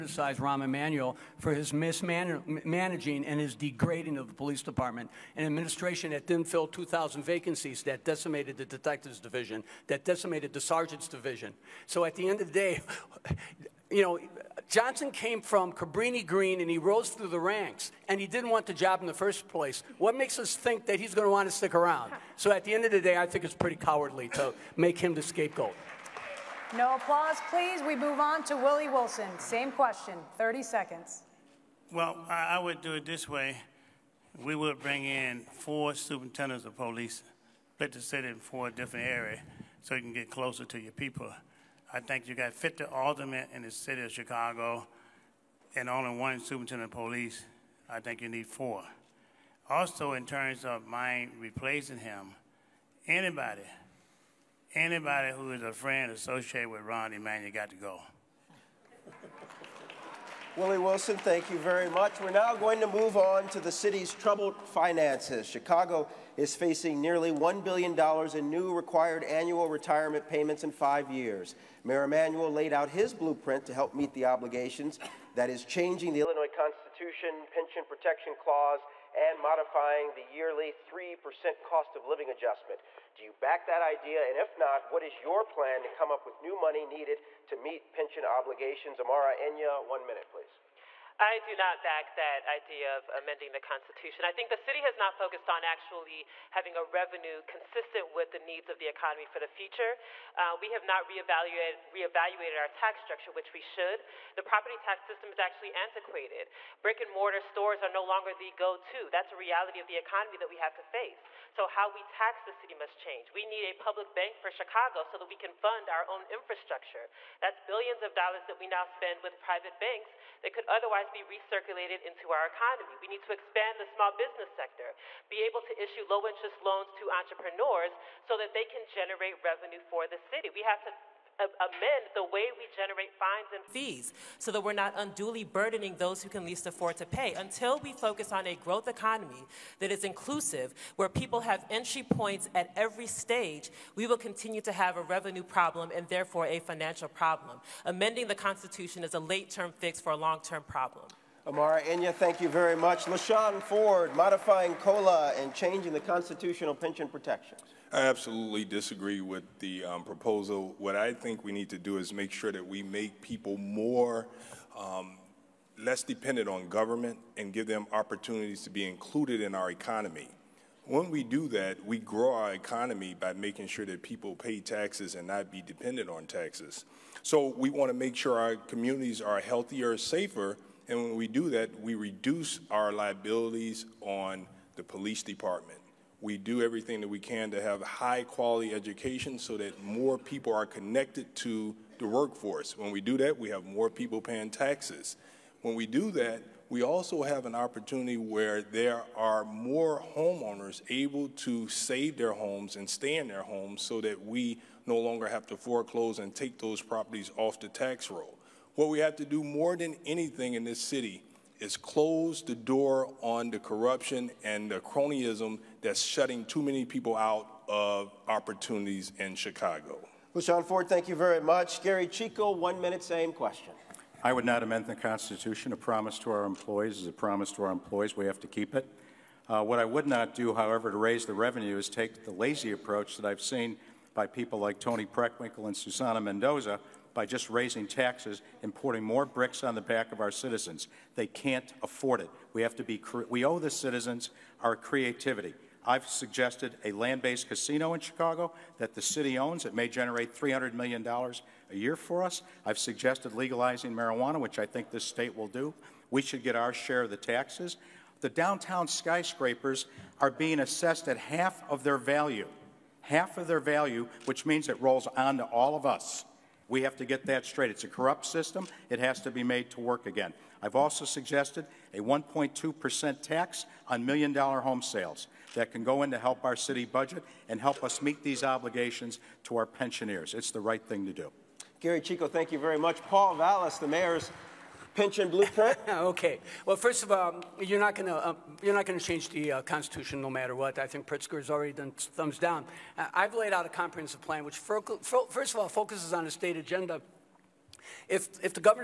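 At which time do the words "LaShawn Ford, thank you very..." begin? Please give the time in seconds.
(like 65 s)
220 s.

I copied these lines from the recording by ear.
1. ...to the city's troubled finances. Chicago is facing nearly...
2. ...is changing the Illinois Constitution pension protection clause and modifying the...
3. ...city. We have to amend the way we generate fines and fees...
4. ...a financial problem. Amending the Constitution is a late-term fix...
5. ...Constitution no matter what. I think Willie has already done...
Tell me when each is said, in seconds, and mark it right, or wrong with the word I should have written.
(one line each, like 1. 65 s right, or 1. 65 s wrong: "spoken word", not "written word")
1. 63 s right
2. 75 s right
3. 130 s right
4. 146 s right
5. 289 s wrong: "Pritzker", not "Willie".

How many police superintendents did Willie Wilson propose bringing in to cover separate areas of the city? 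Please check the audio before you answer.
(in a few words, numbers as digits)
4.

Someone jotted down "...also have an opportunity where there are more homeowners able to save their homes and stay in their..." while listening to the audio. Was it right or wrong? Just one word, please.
right.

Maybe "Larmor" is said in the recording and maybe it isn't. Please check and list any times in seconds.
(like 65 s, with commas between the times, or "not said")
not said.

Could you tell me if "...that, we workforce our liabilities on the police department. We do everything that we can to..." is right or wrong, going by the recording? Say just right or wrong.
wrong.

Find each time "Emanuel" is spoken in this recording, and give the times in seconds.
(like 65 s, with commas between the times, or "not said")
0 s, 57 s, 72 s.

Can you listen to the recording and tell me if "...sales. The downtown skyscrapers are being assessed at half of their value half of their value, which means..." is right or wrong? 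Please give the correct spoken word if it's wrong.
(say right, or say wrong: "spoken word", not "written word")
wrong: "taxes", not "sales".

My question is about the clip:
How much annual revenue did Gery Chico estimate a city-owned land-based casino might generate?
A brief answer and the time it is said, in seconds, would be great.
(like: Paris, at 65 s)
$300 million, at 250 s.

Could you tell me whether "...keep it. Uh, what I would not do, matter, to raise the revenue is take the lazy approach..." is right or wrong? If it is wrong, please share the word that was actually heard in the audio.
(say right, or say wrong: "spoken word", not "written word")
wrong: "however", not "matter".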